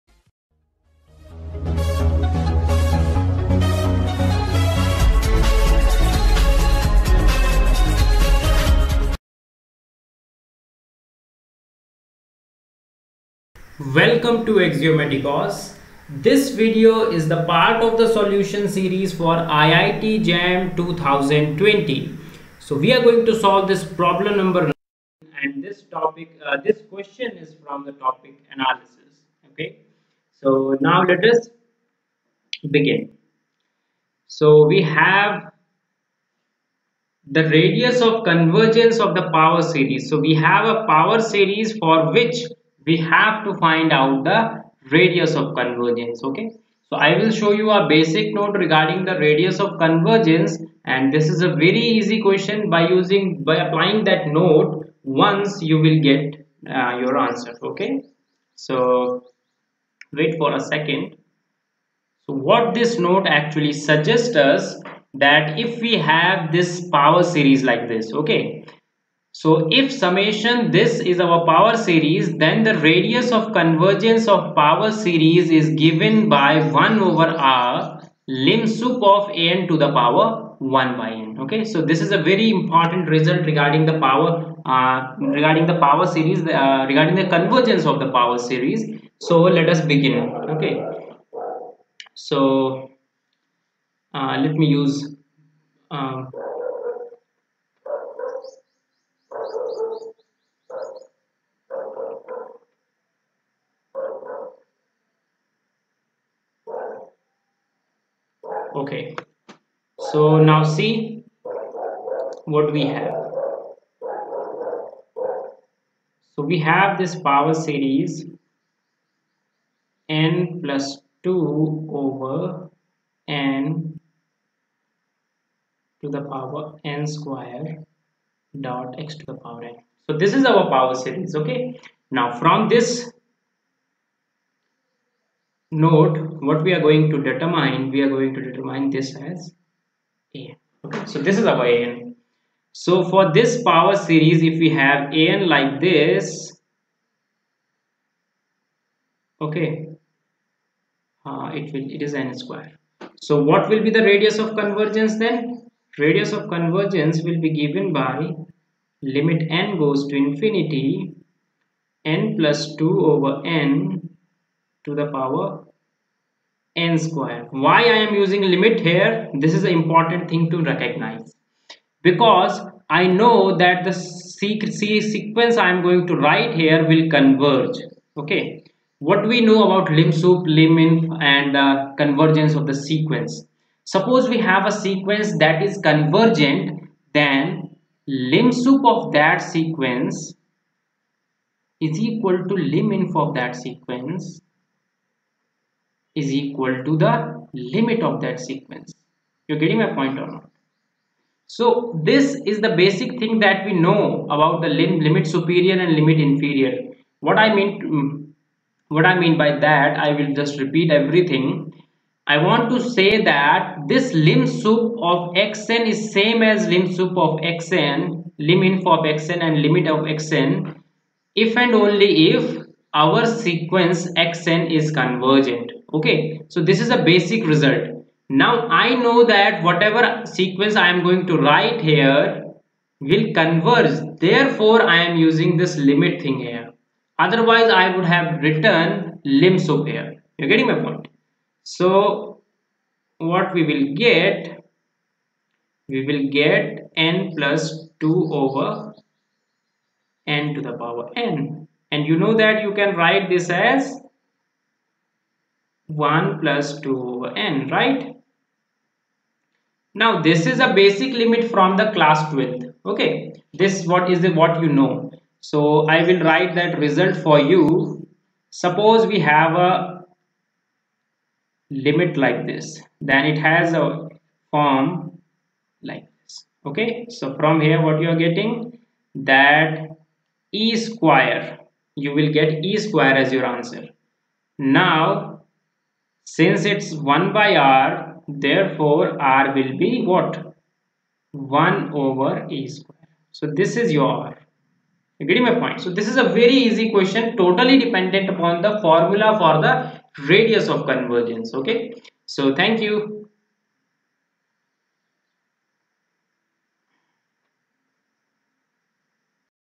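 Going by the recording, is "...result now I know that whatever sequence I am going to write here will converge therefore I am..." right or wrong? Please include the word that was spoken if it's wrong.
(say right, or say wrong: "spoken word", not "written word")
right.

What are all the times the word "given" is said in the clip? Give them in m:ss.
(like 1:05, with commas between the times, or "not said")
1:15, 2:37.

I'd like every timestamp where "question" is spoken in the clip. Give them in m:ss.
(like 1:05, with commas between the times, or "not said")
0:26, 0:52, 4:56.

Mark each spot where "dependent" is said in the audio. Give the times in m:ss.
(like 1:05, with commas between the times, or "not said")
4:57.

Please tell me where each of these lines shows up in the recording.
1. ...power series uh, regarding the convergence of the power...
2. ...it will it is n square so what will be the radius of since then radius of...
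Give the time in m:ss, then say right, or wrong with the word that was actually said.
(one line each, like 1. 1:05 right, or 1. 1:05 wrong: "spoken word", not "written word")
1. 1:25 right
2. 2:31 wrong: "convergence", not "since".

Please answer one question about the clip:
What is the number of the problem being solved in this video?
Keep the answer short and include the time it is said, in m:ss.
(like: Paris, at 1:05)
9, at 0:23.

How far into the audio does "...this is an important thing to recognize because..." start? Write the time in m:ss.
2:49.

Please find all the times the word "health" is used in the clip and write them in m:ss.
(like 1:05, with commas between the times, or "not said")
not said.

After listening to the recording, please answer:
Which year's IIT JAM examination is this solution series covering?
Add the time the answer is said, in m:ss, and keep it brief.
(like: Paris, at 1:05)
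2020, at 0:19.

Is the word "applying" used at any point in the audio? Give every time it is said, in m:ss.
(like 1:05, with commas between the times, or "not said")
0:53.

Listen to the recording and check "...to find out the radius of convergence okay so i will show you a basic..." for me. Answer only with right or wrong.
right.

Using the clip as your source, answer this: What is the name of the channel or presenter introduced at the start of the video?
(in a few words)
Axiomatikos.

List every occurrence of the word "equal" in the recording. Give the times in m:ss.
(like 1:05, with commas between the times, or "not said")
3:12, 3:16.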